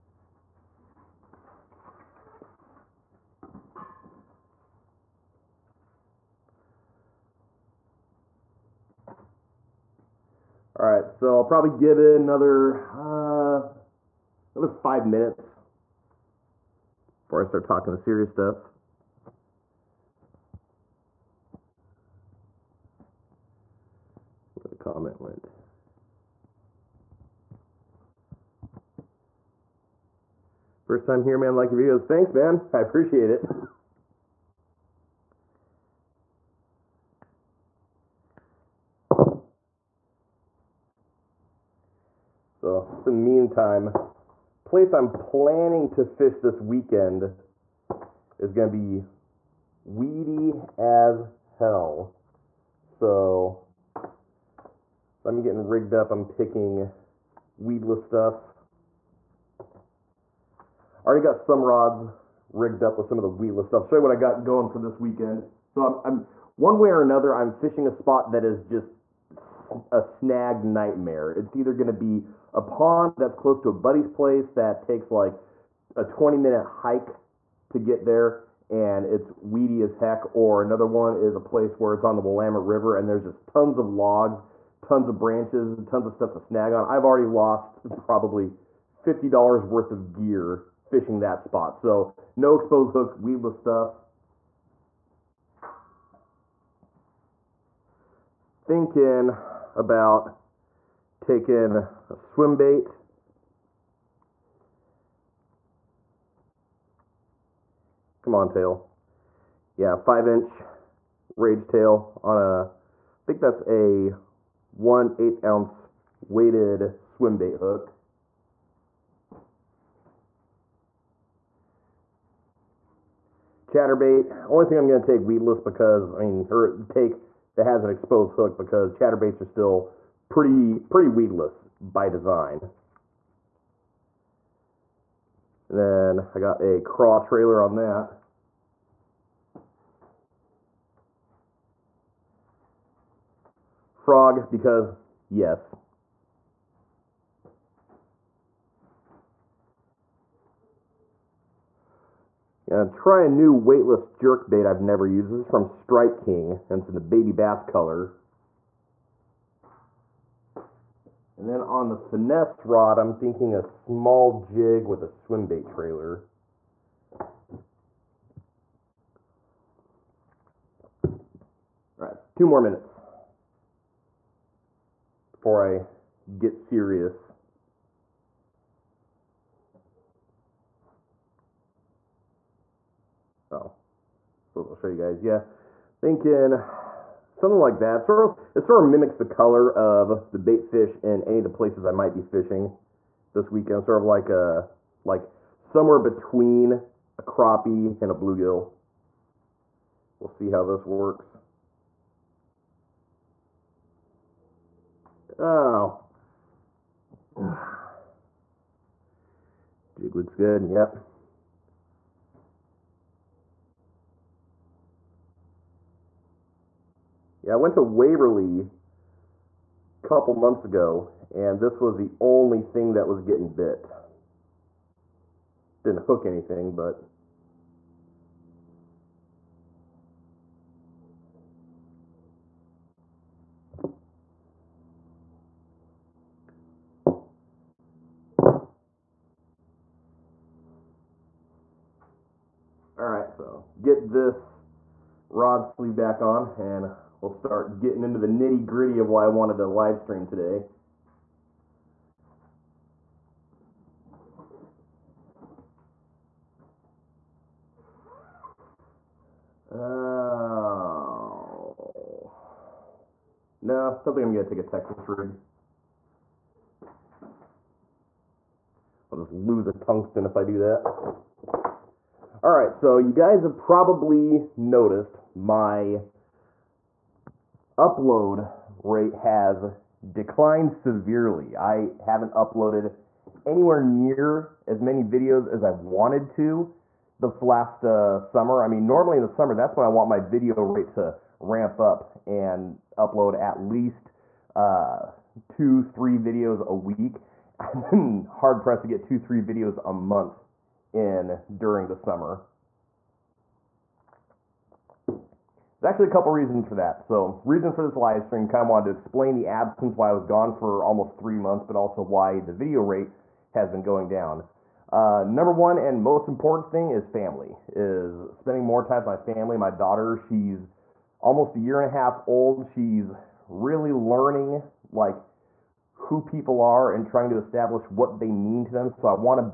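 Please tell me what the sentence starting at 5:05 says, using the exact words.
There's actually a couple reasons for that.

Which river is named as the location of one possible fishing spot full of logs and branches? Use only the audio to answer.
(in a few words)
Willamette River.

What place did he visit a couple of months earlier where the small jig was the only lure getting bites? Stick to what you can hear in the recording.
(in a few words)
Waverly.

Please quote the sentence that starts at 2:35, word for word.
This is from Strike King, and it's in the baby bass color.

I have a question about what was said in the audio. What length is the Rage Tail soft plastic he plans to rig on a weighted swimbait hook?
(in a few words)
5 inch.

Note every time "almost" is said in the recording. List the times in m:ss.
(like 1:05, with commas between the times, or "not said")
5:10, 5:21.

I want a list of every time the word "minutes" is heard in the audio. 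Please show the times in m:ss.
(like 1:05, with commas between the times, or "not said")
0:15, 1:16, 2:52.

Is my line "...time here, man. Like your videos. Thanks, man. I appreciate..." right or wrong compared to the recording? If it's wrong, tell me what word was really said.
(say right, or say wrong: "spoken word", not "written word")
right.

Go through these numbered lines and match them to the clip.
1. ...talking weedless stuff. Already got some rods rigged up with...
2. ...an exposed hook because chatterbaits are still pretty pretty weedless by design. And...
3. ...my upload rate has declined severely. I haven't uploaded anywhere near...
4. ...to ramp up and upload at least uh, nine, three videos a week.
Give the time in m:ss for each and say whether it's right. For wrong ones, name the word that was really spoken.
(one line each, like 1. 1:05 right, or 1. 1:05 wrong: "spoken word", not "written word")
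1. 0:56 wrong: "picking", not "talking"
2. 2:07 right
3. 4:35 right
4. 4:50 wrong: "two", not "nine".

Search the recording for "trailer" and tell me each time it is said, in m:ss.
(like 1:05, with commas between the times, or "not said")
2:17, 2:45.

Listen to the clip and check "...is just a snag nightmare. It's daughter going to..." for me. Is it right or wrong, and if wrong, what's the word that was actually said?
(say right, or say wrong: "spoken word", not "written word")
wrong: "either", not "daughter".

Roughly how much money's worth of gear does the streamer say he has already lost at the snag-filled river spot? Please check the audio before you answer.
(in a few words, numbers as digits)
$50.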